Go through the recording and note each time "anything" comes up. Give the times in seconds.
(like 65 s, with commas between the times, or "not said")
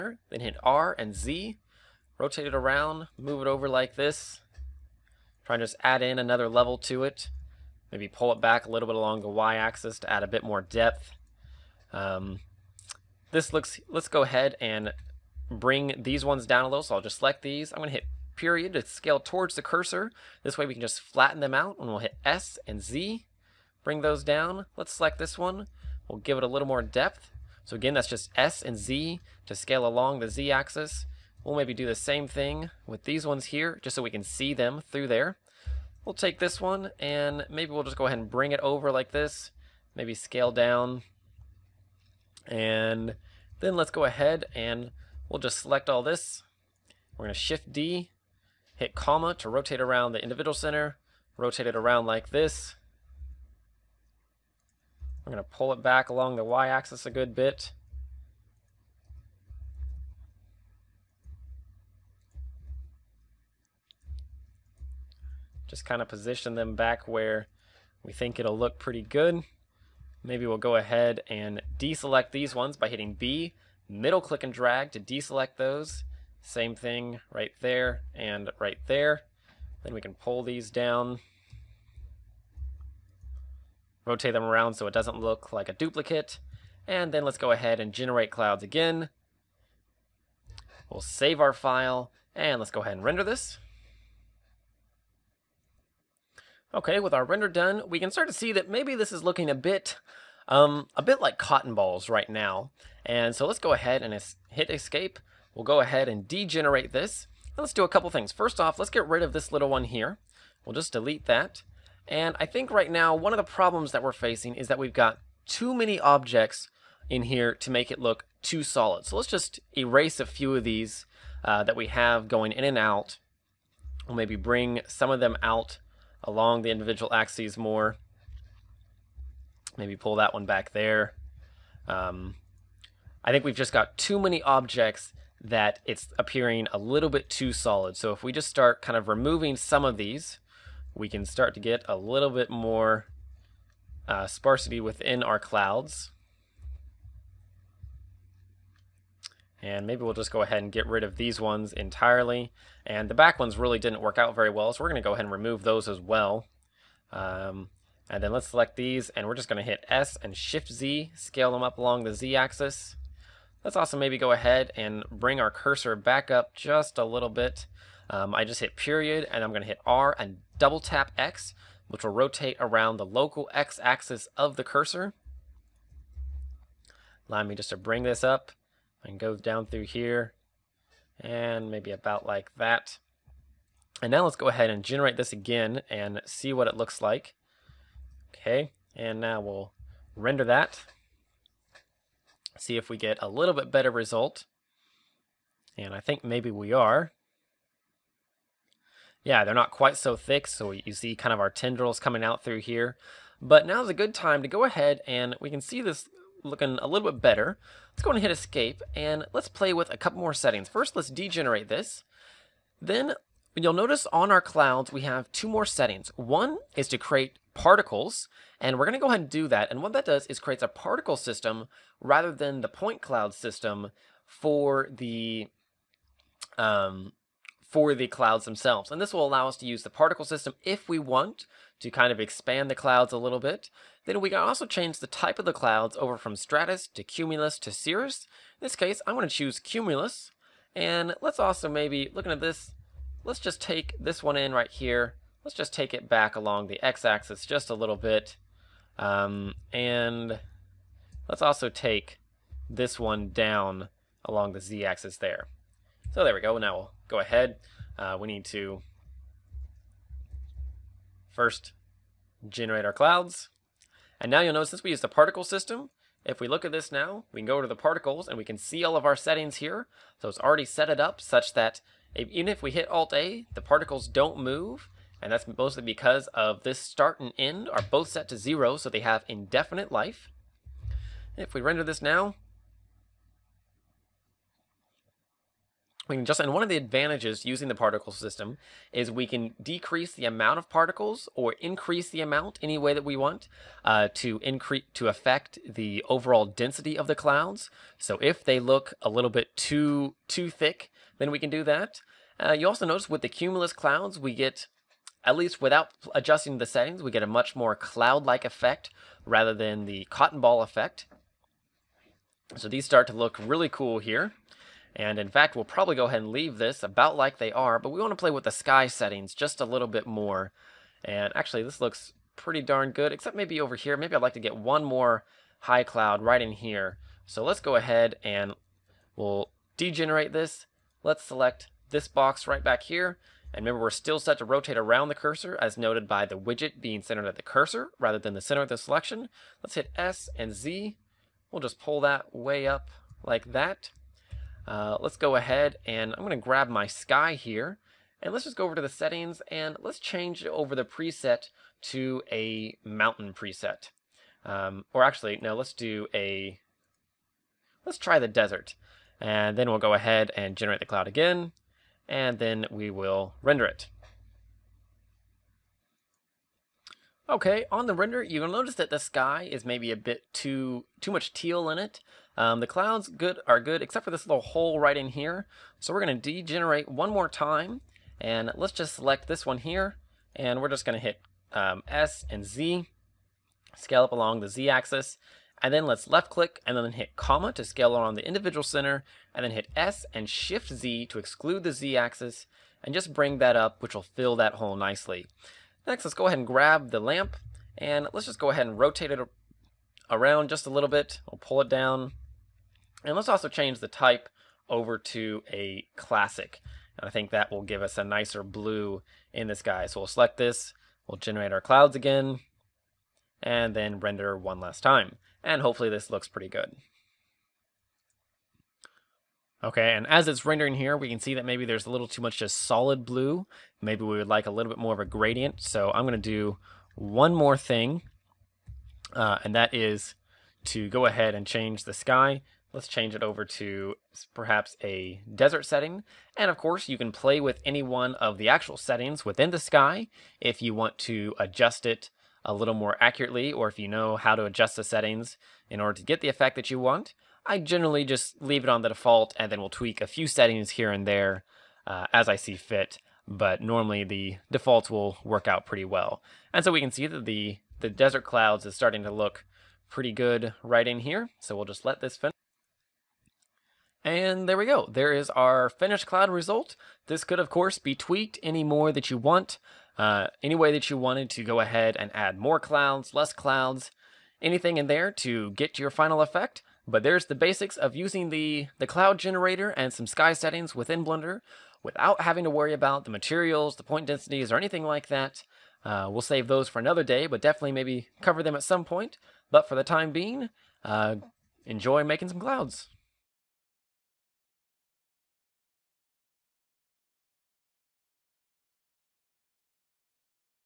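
474 s, 484 s.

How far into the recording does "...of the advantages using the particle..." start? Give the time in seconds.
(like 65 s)
286 s.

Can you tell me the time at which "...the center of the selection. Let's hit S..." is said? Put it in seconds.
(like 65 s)
338 s.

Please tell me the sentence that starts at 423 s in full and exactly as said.
Maybe we would like a little bit more of a gradient.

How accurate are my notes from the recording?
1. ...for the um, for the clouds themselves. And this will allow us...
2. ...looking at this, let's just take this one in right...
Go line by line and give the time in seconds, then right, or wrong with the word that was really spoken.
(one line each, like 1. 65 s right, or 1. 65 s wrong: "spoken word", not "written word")
1. 224 s right
2. 242 s right.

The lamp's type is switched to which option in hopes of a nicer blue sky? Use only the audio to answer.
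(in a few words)
Classic.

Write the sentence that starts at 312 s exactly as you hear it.
So these start to look really cool here.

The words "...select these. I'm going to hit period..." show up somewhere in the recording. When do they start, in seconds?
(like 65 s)
17 s.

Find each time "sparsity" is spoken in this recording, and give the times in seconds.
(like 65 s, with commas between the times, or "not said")
144 s.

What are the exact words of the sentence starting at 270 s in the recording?
So it's already set it up such that even if we hit Alt-A, the particles don't move.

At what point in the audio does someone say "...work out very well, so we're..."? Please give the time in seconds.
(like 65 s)
154 s.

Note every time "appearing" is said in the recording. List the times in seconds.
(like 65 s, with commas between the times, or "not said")
136 s.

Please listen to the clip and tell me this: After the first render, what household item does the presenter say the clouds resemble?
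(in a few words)
Cotton balls.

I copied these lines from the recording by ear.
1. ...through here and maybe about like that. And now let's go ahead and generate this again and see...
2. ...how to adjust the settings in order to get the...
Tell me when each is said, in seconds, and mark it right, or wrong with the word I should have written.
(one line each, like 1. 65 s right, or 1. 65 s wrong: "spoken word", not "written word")
1. 179 s right
2. 444 s right.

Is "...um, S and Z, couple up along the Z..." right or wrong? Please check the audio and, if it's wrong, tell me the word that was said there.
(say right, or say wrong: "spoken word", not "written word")
wrong: "scale", not "couple".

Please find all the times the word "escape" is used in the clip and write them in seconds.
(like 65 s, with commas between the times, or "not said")
104 s, 208 s.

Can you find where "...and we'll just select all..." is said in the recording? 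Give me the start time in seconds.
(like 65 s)
44 s.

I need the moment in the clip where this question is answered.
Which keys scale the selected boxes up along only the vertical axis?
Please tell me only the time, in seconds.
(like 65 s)
159 s.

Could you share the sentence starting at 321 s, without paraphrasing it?
And actually, this looks pretty darn good, except maybe over here.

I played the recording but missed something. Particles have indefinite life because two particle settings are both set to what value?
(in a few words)
0.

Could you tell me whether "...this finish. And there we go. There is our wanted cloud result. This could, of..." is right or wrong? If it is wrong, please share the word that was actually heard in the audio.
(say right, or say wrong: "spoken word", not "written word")
wrong: "finished", not "wanted".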